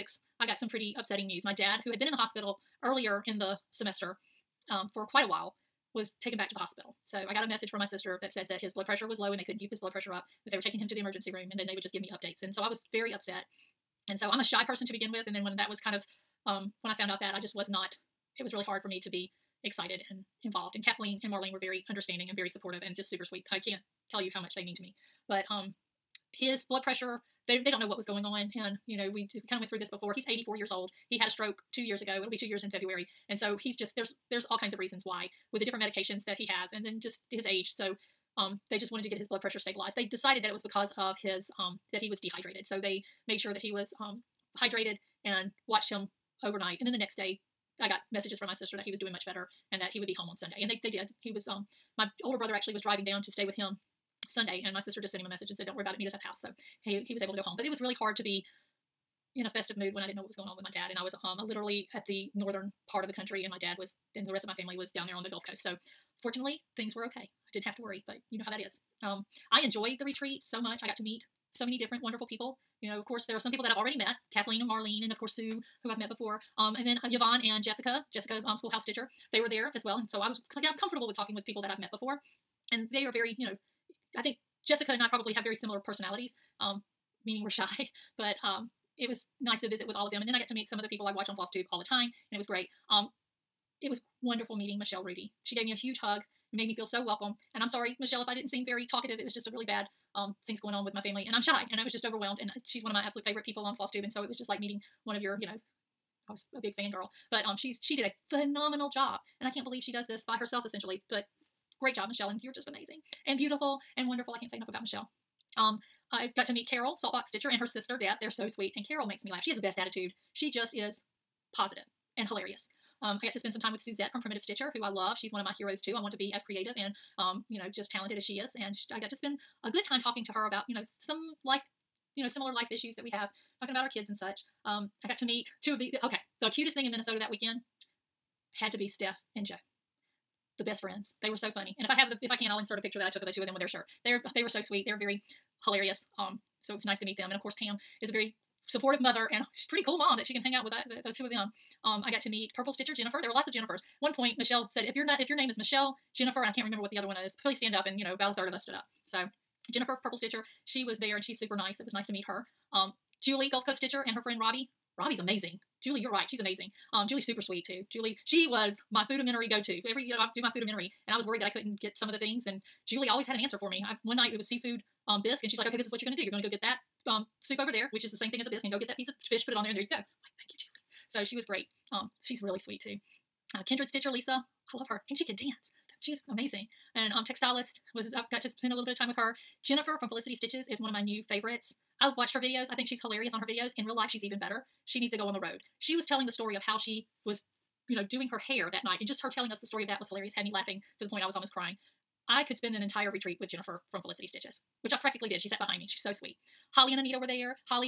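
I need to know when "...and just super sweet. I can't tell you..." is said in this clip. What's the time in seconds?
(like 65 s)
22 s.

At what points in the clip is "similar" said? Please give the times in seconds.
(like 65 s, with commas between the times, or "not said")
85 s, 132 s.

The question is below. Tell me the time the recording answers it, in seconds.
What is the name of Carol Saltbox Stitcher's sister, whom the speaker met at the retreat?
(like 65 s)
117 s.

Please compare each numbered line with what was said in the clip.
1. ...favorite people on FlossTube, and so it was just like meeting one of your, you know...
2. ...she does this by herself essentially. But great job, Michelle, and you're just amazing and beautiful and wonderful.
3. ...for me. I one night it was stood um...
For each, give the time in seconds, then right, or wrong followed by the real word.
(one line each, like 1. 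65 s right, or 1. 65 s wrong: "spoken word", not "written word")
1. 103 s right
2. 109 s right
3. 173 s wrong: "seafood", not "stood".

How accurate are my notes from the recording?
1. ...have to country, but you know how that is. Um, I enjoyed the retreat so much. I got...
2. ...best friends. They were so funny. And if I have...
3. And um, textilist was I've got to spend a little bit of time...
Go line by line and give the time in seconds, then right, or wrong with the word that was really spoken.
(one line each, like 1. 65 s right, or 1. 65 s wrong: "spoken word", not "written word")
1. 67 s wrong: "worry", not "country"
2. 140 s right
3. 186 s right.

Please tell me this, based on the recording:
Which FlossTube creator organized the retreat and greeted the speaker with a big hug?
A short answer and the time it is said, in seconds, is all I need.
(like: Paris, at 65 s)
Michelle Rudy, at 94 s.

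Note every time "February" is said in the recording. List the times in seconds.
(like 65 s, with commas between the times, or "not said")
32 s.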